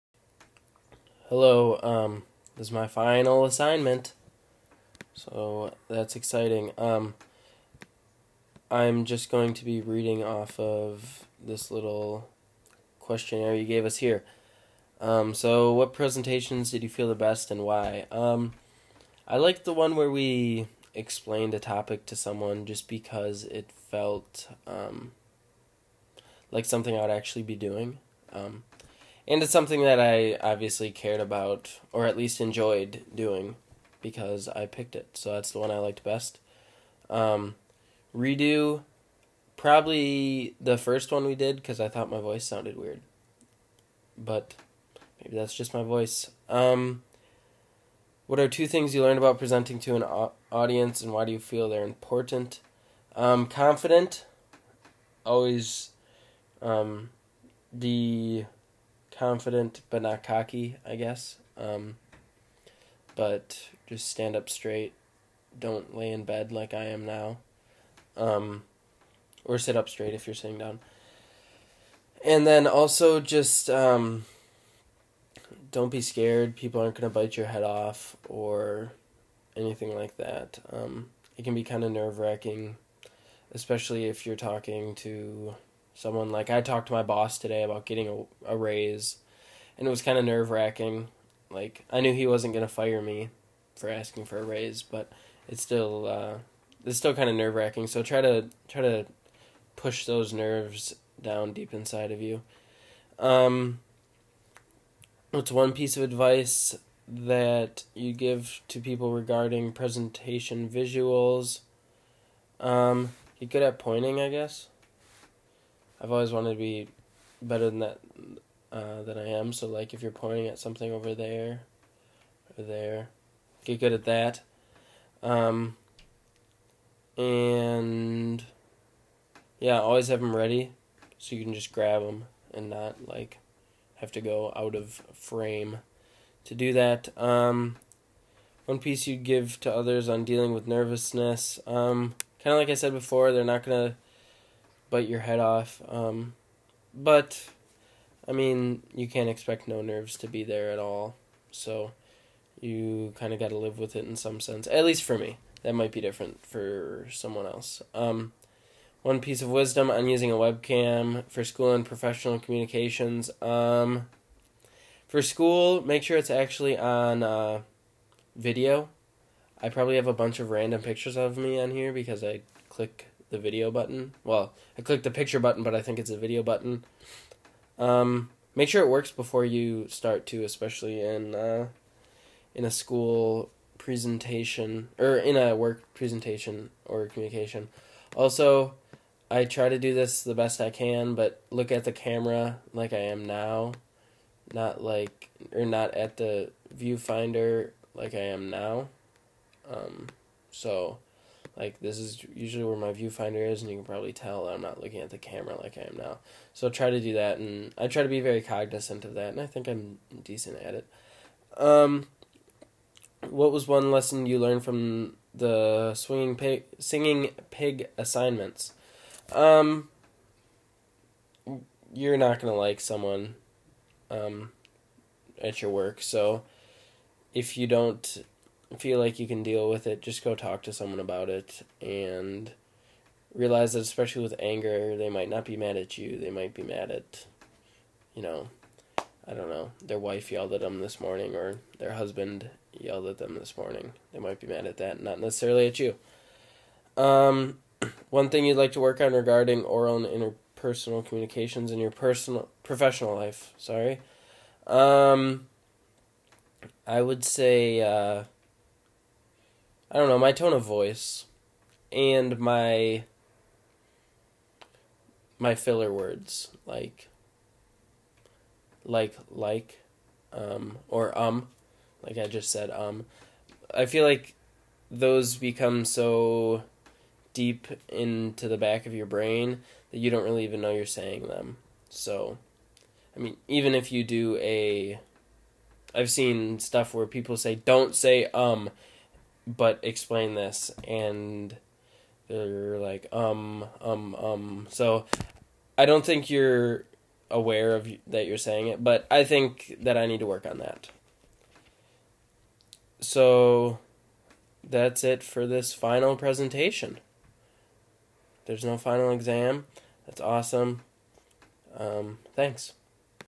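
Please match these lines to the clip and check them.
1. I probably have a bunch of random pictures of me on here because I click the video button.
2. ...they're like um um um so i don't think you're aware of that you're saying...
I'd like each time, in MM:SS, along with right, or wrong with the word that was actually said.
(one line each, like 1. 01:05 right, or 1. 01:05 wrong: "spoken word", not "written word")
1. 02:49 right
2. 04:52 right.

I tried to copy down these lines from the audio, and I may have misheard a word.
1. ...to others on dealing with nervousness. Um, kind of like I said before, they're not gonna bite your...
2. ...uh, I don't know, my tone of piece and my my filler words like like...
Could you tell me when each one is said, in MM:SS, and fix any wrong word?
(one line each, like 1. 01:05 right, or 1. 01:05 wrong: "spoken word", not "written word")
1. 02:19 right
2. 04:17 wrong: "voice", not "piece".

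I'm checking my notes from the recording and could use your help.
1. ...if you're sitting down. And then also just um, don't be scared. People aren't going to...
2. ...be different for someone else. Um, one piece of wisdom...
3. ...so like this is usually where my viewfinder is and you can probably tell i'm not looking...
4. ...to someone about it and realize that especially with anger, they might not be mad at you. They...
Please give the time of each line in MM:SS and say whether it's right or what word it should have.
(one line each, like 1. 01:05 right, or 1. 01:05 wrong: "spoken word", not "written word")
1. 01:10 right
2. 02:35 right
3. 03:20 right
4. 03:50 right.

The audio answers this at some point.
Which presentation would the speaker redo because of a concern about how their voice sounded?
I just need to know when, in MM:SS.
00:40.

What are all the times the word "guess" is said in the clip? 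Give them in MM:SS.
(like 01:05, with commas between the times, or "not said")
01:00, 01:54.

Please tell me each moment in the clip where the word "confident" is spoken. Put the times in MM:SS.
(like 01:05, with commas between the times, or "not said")
00:53, 00:59.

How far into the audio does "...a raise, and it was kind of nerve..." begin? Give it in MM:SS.
01:28.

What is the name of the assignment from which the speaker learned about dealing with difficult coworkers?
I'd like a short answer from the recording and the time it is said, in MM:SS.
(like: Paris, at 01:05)
singing pig, at 03:36.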